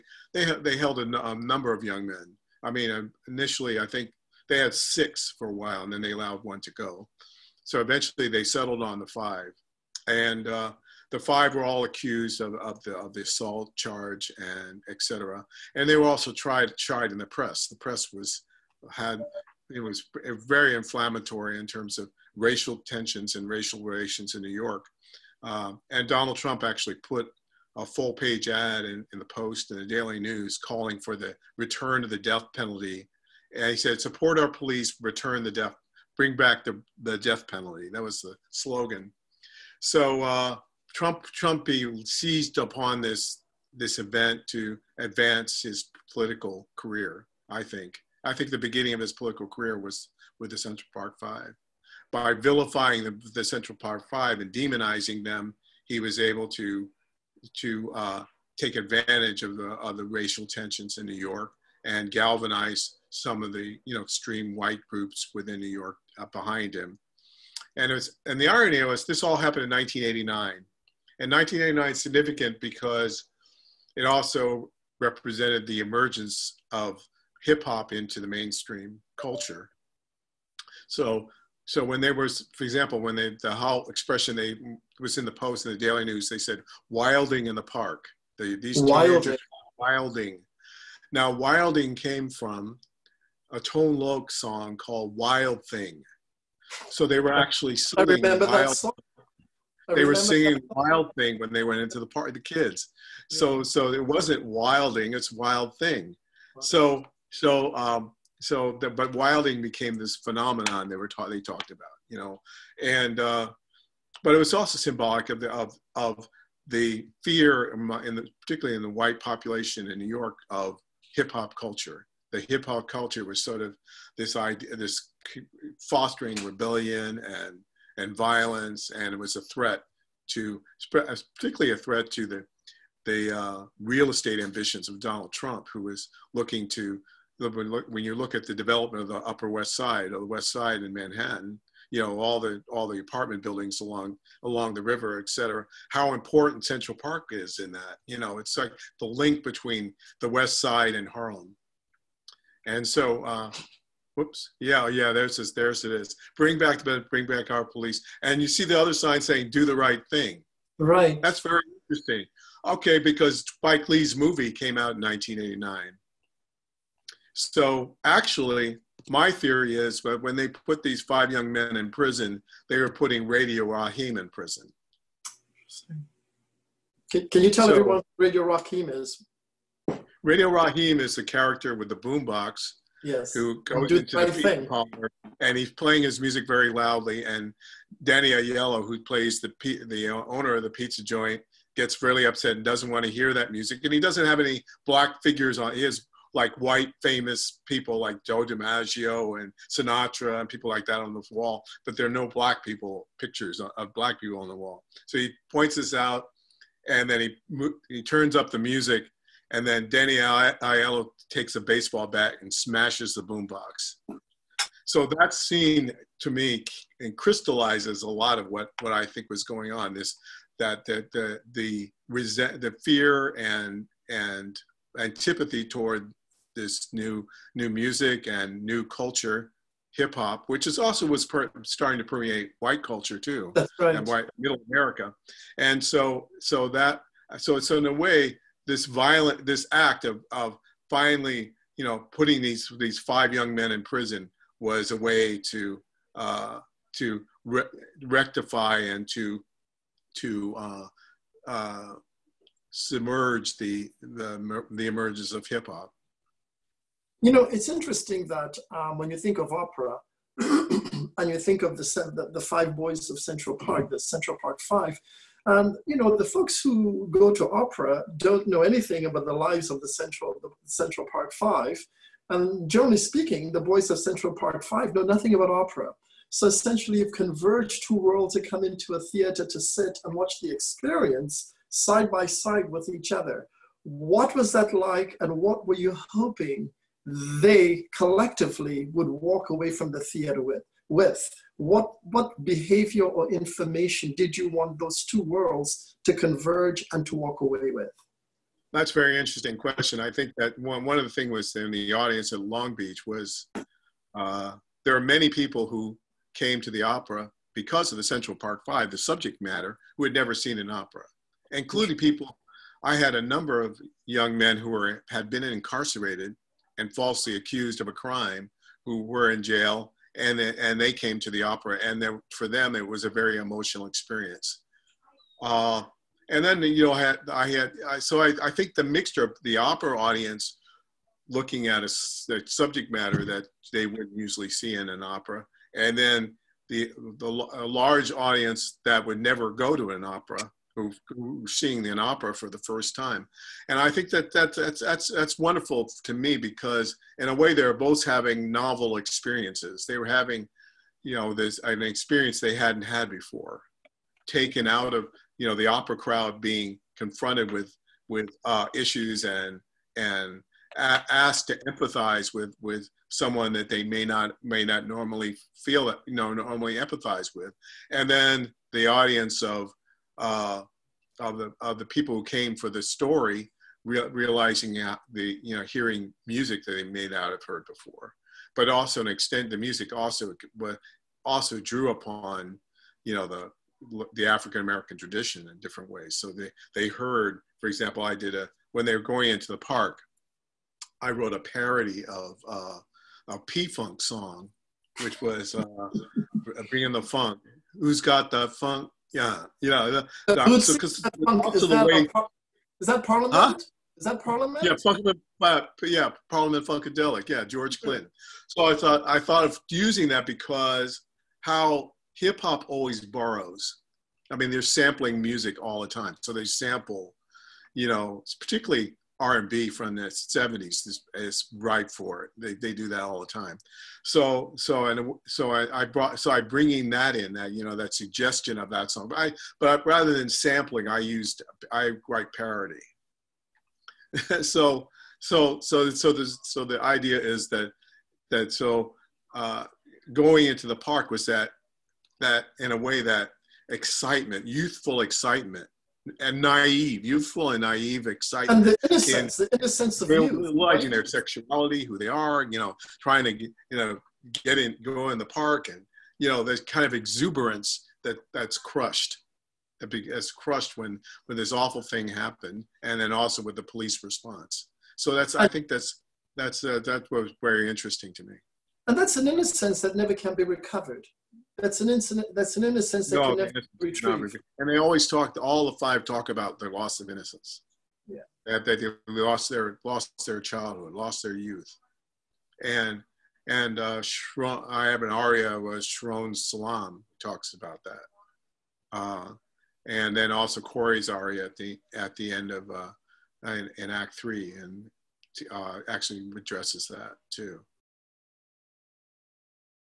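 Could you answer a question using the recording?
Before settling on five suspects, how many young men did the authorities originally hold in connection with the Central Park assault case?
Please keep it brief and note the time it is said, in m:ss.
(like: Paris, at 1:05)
6, at 0:04.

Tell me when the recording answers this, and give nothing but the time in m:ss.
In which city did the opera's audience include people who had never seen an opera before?
5:02.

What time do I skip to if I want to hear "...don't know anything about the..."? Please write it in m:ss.
4:28.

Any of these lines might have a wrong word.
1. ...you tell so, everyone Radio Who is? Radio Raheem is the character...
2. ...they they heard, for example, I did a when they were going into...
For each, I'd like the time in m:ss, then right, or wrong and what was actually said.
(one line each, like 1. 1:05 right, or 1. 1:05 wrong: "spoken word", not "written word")
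1. 2:57 wrong: "Raheem", not "Who"
2. 6:26 right.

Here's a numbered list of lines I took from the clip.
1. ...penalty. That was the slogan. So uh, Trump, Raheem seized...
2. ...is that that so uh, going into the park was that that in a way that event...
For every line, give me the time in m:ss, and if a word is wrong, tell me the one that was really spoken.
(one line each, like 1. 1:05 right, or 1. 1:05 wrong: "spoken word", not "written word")
1. 0:37 wrong: "Trumpy", not "Raheem"
2. 7:17 wrong: "excitement", not "event".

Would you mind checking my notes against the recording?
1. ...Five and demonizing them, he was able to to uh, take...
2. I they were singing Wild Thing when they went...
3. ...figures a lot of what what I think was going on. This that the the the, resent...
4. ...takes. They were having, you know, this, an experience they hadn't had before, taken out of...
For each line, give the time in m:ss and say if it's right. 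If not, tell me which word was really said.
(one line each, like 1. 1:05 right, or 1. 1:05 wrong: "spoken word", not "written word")
1. 0:54 right
2. 1:39 right
3. 3:37 wrong: "crystallizes", not "figures"
4. 5:48 wrong: "experiences", not "takes".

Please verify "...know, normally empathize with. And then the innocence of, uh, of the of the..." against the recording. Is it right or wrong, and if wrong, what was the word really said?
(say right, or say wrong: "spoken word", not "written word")
wrong: "audience", not "innocence".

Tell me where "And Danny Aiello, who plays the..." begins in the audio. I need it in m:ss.
3:07.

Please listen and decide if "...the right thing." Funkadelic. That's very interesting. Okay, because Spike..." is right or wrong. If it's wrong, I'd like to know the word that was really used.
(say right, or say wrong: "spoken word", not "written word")
wrong: "Right", not "Funkadelic".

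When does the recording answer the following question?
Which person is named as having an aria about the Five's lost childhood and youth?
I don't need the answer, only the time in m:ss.
8:05.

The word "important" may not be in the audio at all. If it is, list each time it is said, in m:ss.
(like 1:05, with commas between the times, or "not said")
2:26.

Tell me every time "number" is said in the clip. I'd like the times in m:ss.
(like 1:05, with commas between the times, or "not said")
0:01, 5:13.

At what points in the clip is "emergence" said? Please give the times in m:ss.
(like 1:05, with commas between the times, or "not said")
1:15, 4:14.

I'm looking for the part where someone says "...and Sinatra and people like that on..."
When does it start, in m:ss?
3:19.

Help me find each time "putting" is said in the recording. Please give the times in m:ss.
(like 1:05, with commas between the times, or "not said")
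2:52, 4:02.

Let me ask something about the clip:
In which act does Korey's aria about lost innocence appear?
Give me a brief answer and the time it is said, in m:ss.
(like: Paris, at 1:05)
Act Three, at 8:13.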